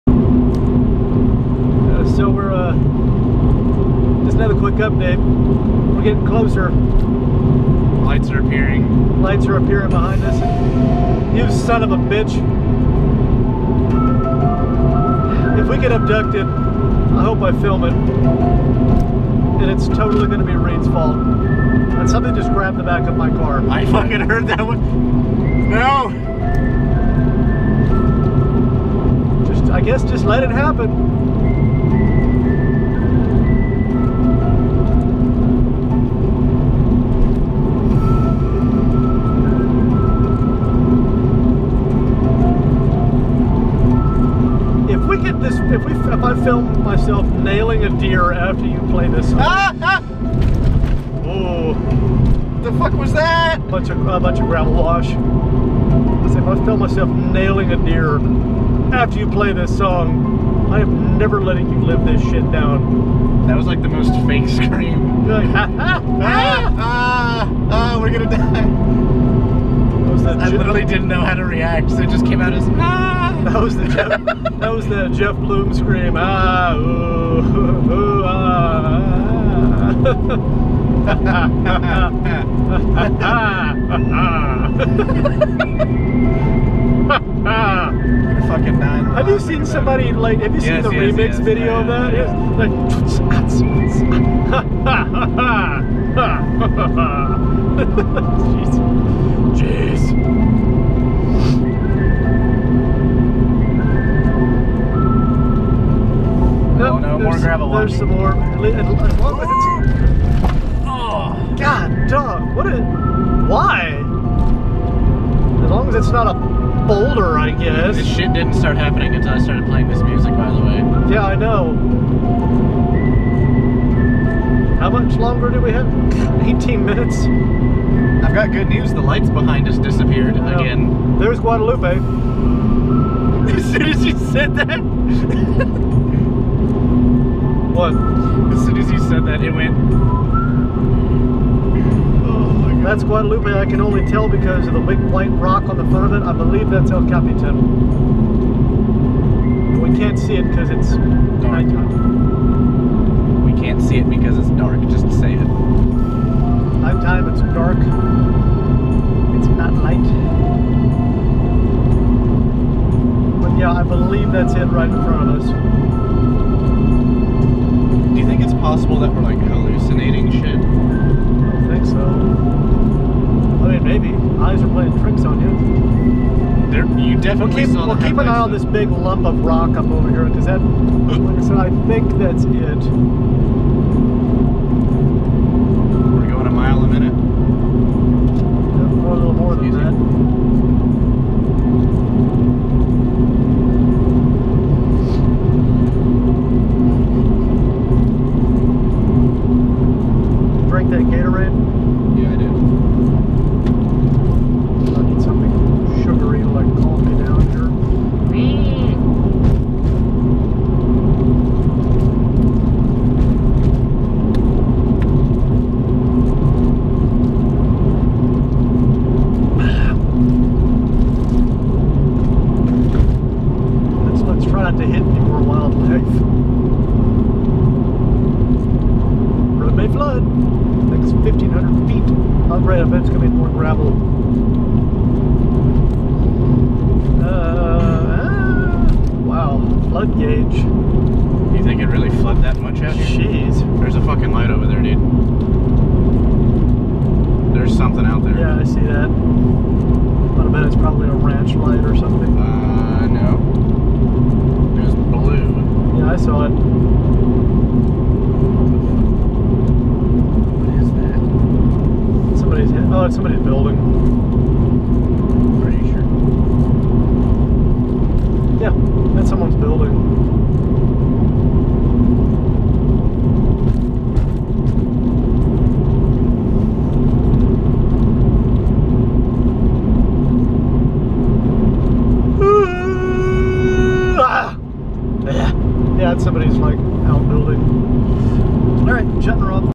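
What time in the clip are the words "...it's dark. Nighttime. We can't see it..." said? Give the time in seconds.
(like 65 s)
150 s.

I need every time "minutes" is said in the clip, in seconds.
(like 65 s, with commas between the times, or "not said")
126 s, 186 s.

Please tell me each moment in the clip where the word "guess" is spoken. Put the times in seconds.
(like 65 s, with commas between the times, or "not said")
29 s, 117 s.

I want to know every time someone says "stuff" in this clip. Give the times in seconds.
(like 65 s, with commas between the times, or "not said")
not said.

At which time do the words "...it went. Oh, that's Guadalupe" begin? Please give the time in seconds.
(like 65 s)
139 s.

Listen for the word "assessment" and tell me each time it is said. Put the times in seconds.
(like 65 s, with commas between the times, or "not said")
not said.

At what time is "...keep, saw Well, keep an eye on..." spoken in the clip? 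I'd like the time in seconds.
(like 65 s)
177 s.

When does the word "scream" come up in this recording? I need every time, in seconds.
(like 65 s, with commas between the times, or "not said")
64 s, 75 s.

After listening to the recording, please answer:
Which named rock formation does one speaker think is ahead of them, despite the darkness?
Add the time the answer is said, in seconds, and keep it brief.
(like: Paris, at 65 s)
El Capitan, at 146 s.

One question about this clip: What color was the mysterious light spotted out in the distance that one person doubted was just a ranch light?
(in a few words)
Blue.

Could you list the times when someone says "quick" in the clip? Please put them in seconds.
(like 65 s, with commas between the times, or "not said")
4 s.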